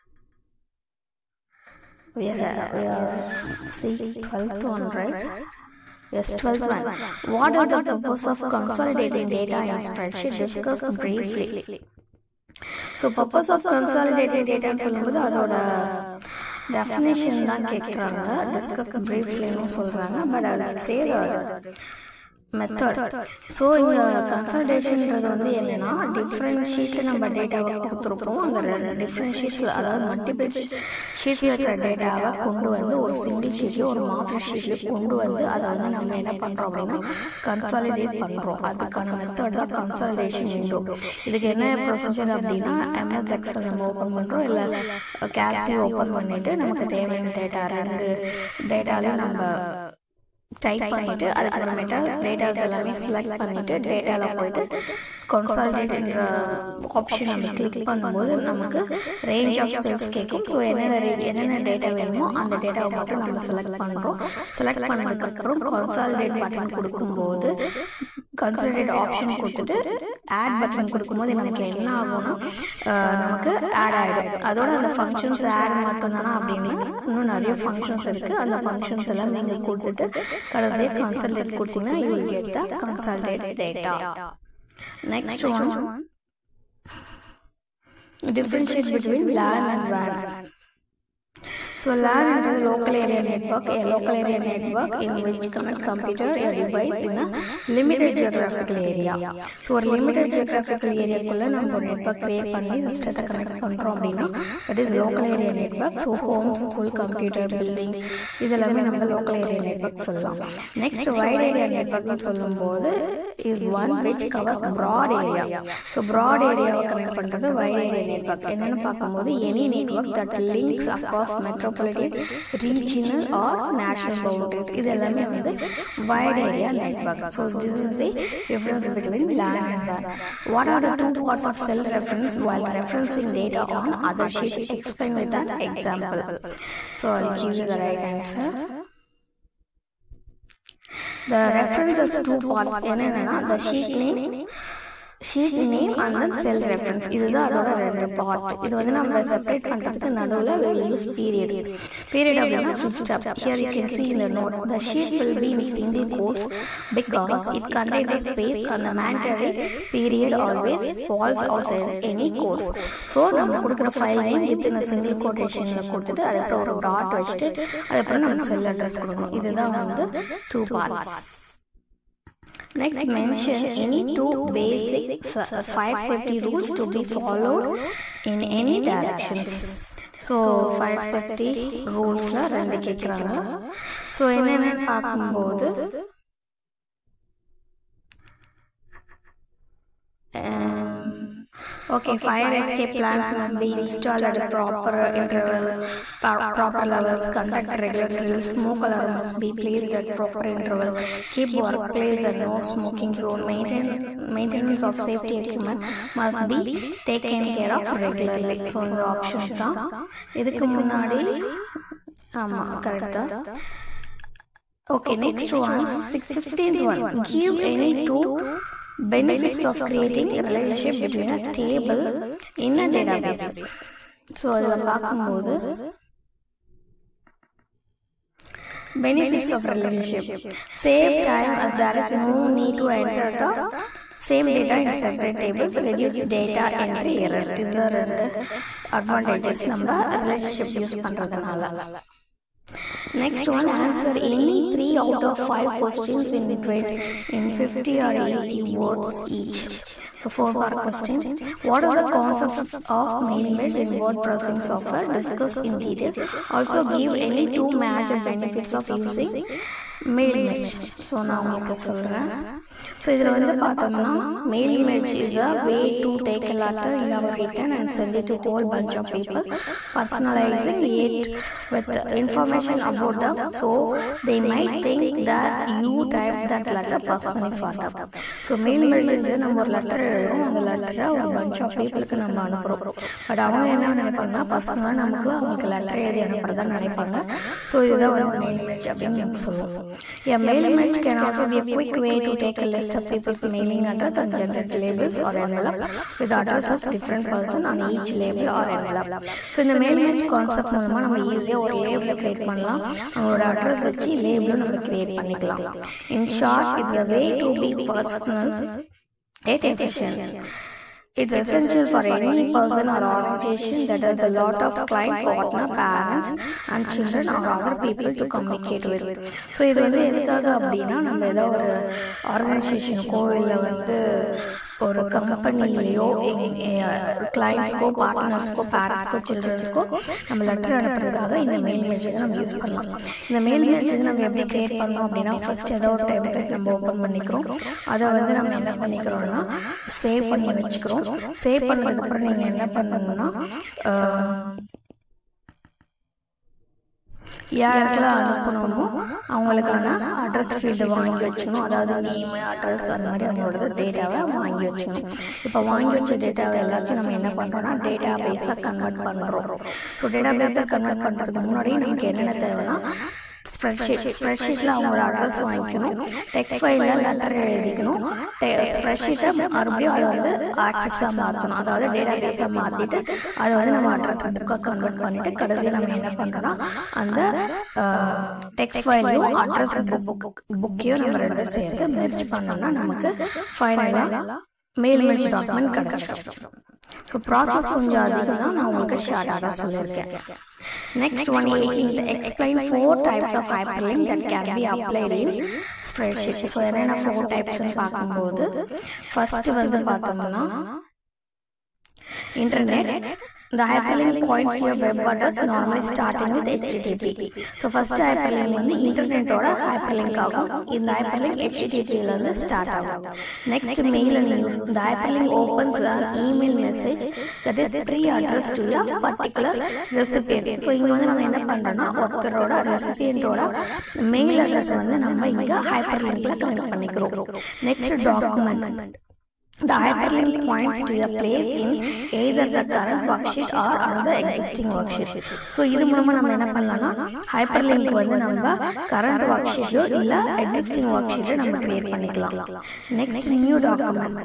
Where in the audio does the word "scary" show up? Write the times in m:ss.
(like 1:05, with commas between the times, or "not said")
not said.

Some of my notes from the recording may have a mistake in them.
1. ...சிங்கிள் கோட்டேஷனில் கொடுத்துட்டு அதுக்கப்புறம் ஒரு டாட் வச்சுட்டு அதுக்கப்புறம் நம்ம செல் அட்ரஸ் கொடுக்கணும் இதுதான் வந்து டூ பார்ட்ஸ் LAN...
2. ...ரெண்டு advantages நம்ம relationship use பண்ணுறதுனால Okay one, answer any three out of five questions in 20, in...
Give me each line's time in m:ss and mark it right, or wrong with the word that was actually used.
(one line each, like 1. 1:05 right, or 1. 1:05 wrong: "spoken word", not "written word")
1. 2:44 wrong: "Next", not "LAN"
2. 3:57 wrong: "Next", not "Okay".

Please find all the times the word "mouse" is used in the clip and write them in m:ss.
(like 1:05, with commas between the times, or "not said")
not said.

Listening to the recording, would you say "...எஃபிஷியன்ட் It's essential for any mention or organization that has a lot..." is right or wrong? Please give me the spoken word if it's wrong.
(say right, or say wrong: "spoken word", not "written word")
wrong: "person", not "mention".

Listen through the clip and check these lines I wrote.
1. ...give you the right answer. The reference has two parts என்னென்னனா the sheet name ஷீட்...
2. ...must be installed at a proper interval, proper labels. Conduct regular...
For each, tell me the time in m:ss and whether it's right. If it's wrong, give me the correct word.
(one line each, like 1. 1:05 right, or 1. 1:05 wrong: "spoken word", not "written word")
1. 2:17 right
2. 3:13 wrong: "levels", not "labels".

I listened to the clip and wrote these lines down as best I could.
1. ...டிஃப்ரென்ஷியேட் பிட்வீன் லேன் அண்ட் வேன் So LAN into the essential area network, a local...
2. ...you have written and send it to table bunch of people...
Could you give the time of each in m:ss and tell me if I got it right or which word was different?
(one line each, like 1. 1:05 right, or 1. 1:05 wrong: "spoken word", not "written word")
1. 1:28 wrong: "local", not "essential"
2. 4:27 wrong: "whole", not "table".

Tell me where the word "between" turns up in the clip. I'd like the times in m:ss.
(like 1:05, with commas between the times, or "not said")
2:08, 3:40.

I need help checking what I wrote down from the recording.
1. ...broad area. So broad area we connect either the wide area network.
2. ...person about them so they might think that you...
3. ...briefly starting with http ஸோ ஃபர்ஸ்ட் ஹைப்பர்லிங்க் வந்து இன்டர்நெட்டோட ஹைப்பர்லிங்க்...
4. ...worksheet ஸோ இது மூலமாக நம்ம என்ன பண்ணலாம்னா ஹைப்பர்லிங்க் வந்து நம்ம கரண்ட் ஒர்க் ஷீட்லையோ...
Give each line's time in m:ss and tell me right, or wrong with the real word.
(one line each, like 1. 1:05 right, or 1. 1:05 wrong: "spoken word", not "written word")
1. 1:54 wrong: "under", not "either"
2. 4:32 wrong: "information", not "person"
3. 6:45 wrong: "normally", not "briefly"
4. 7:14 right.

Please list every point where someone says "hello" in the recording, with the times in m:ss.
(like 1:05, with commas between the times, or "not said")
not said.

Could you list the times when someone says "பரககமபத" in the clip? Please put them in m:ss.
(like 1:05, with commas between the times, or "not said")
3:44, 6:37.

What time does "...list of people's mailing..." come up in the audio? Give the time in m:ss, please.
4:52.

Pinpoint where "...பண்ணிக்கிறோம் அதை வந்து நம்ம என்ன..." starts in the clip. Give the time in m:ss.
5:37.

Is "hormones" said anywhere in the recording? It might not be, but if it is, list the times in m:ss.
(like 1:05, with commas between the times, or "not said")
not said.